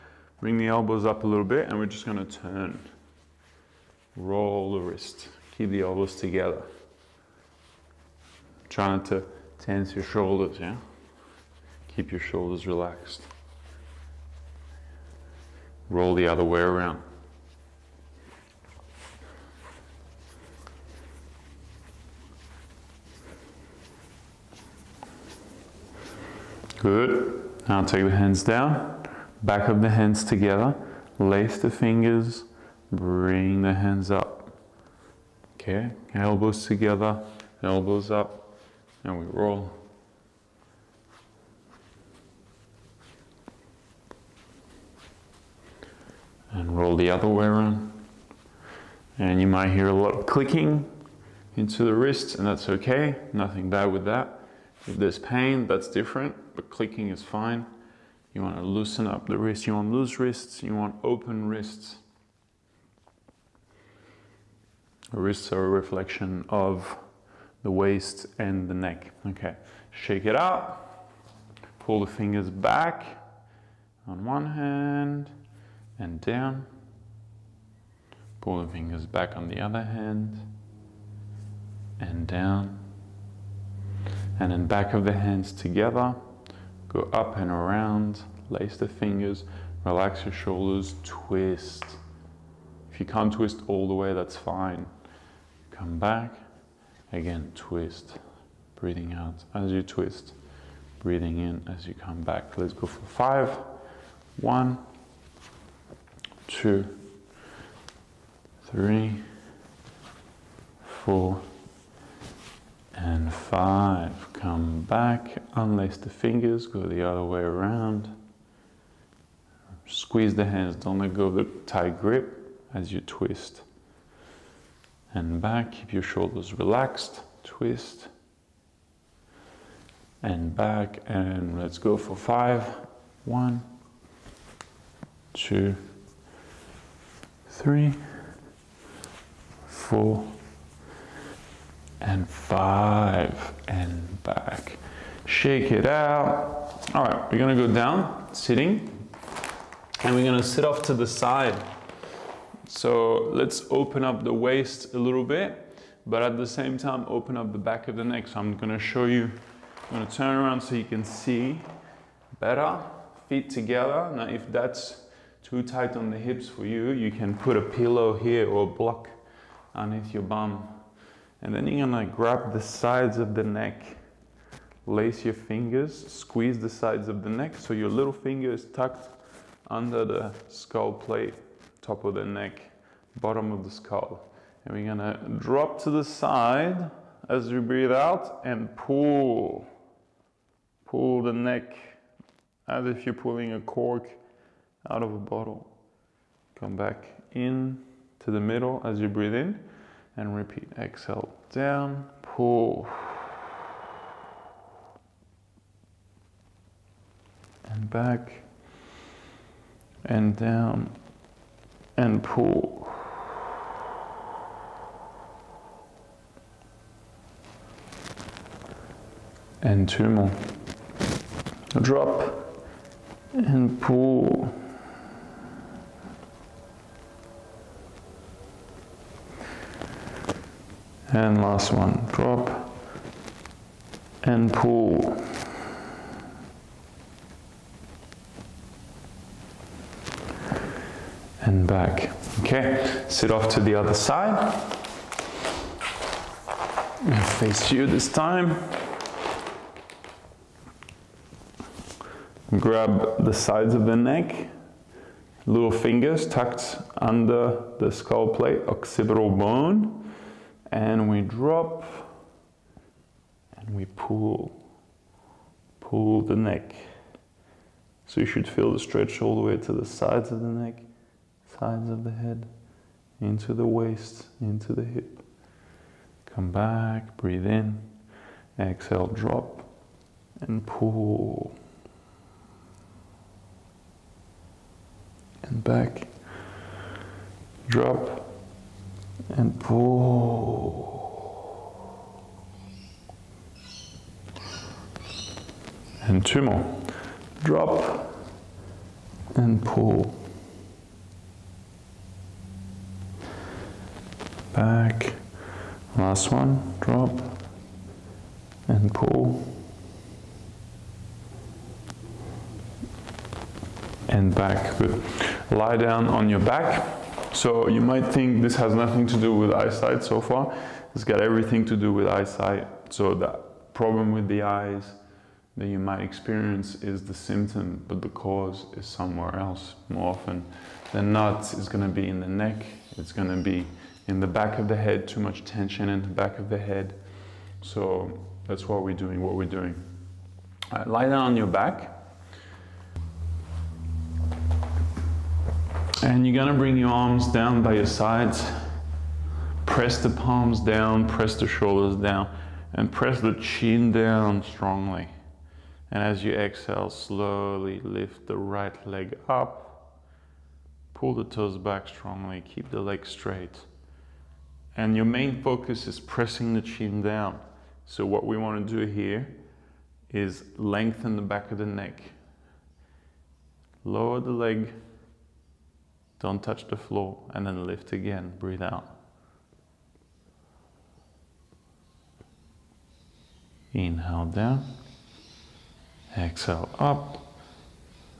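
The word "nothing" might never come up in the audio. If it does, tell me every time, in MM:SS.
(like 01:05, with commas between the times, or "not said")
00:53, 05:18.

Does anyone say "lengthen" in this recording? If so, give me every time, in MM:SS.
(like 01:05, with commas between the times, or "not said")
06:10.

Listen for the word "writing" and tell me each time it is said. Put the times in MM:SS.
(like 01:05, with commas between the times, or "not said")
not said.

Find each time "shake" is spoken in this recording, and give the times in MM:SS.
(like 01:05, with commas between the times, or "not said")
01:09, 02:25.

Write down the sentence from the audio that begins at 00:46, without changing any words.
And roll the other way around.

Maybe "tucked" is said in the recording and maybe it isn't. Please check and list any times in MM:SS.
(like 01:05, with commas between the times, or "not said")
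02:58, 04:16.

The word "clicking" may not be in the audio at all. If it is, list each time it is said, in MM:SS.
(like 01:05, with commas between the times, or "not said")
00:50, 00:56.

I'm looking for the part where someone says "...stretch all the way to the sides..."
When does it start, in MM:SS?
04:28.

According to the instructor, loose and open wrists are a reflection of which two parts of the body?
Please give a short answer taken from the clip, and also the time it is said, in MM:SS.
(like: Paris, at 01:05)
The waist and the neck, at 01:07.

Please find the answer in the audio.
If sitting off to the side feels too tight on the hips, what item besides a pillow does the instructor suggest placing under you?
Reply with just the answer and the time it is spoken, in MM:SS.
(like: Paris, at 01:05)
A block, at 02:48.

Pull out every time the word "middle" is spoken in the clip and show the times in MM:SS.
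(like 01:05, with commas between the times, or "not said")
03:18.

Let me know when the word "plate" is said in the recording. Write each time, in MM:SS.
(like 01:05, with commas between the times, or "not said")
03:00, 04:18.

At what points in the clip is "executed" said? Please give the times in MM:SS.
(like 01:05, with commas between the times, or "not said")
not said.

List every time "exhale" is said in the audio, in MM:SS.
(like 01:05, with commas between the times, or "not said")
03:20, 04:38, 05:56, 06:26.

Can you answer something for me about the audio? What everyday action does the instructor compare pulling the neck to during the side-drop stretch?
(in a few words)
Pulling a cork out of a bottle.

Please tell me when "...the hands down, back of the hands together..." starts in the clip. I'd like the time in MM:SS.
00:28.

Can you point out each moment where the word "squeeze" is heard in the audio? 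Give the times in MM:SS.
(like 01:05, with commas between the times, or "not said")
01:59, 02:56.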